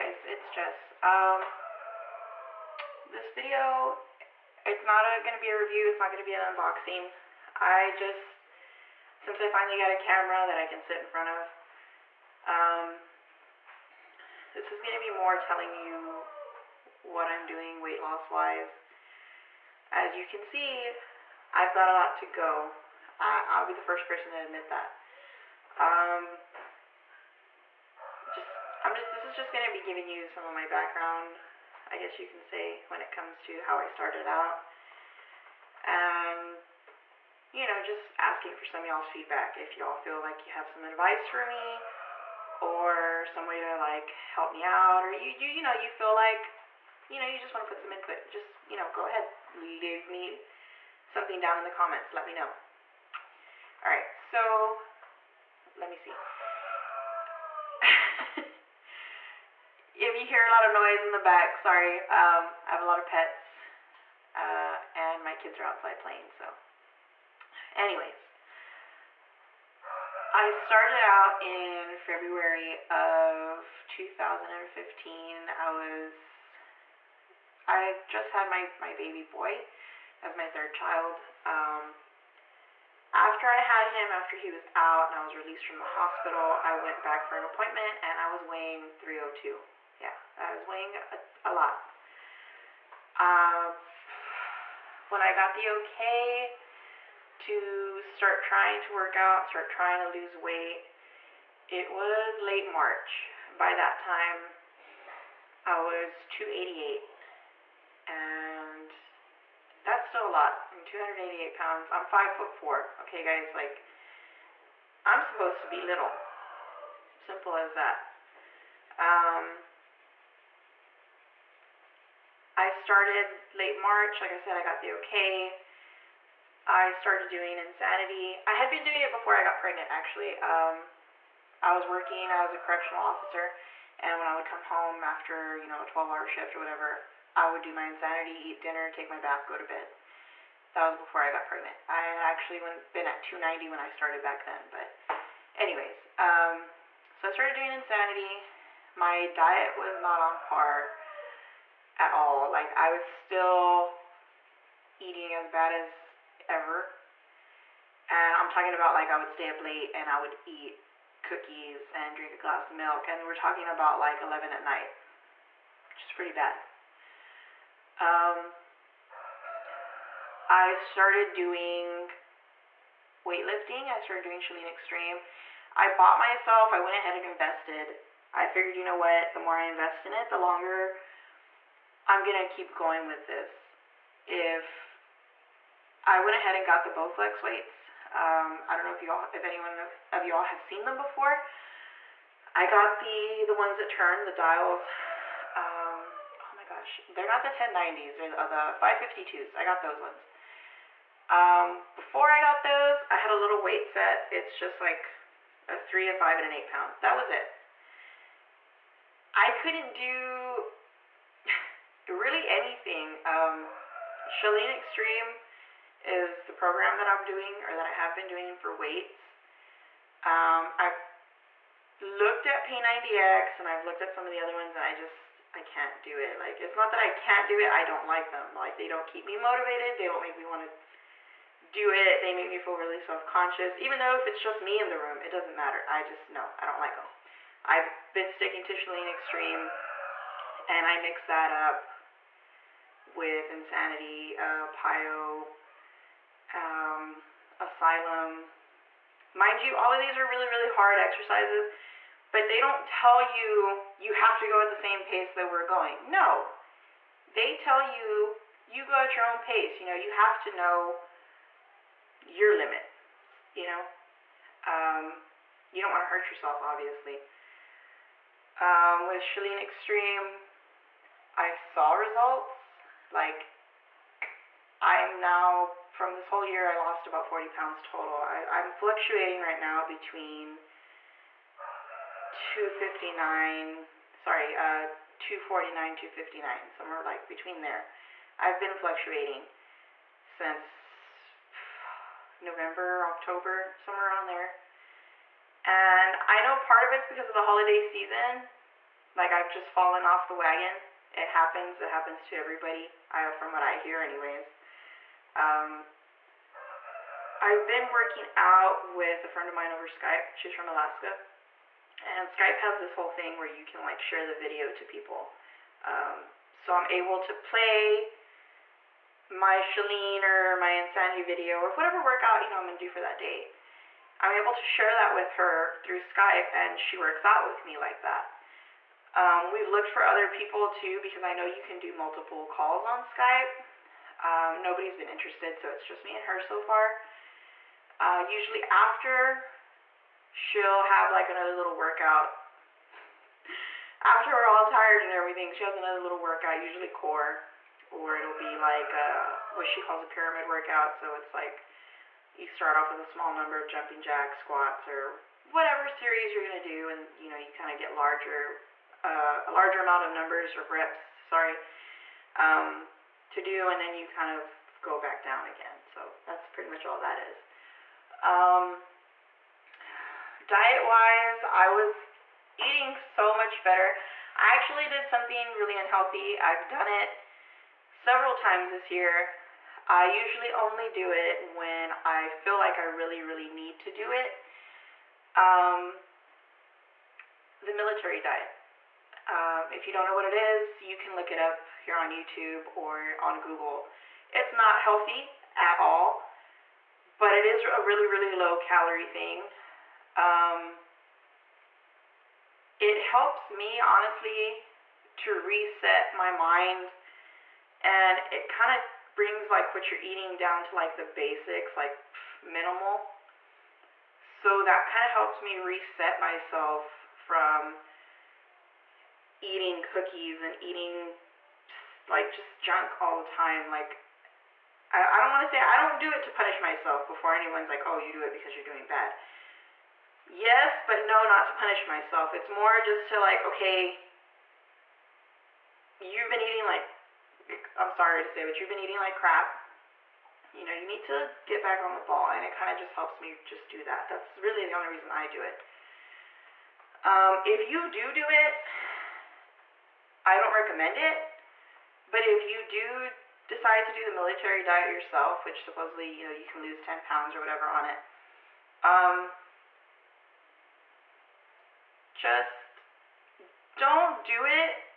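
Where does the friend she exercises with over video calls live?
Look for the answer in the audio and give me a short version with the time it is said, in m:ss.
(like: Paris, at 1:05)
Alaska, at 5:10.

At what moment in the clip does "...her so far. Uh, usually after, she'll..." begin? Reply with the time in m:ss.
5:36.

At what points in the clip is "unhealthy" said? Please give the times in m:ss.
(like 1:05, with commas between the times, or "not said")
6:15.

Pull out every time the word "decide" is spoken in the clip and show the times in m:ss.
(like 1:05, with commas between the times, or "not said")
7:33.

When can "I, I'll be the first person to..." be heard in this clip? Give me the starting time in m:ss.
0:23.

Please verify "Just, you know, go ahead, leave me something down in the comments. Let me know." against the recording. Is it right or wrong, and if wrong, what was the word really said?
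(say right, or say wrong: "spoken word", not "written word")
right.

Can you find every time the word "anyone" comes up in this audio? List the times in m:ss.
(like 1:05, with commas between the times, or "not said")
3:09, 7:07.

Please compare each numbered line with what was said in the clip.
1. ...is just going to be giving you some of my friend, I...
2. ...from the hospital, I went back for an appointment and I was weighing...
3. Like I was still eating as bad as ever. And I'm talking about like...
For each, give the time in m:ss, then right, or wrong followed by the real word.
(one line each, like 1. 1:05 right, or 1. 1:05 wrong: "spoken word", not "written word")
1. 0:29 wrong: "background", not "friend"
2. 1:25 right
3. 2:32 right.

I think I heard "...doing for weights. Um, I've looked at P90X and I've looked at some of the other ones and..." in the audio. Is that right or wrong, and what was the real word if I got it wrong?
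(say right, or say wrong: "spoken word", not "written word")
right.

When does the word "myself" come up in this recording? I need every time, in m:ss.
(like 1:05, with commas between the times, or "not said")
2:56, 6:56, 7:06, 7:11.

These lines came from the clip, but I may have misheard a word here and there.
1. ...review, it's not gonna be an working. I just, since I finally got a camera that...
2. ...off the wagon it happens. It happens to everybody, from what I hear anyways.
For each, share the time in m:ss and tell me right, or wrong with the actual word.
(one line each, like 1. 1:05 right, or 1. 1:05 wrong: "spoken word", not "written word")
1. 0:05 wrong: "unboxing", not "working"
2. 5:00 right.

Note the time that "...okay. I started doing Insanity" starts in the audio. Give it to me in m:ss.
2:04.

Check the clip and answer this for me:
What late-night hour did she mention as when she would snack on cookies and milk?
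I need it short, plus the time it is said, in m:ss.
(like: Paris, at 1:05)
11, at 2:44.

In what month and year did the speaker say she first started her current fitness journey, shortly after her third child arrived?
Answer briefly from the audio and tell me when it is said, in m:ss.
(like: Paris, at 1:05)
February 2015, at 1:11.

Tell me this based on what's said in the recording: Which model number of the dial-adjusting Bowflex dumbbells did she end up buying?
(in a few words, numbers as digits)
552s.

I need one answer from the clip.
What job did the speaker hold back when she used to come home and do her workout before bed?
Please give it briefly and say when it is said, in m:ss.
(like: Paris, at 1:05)
Correctional officer, at 2:12.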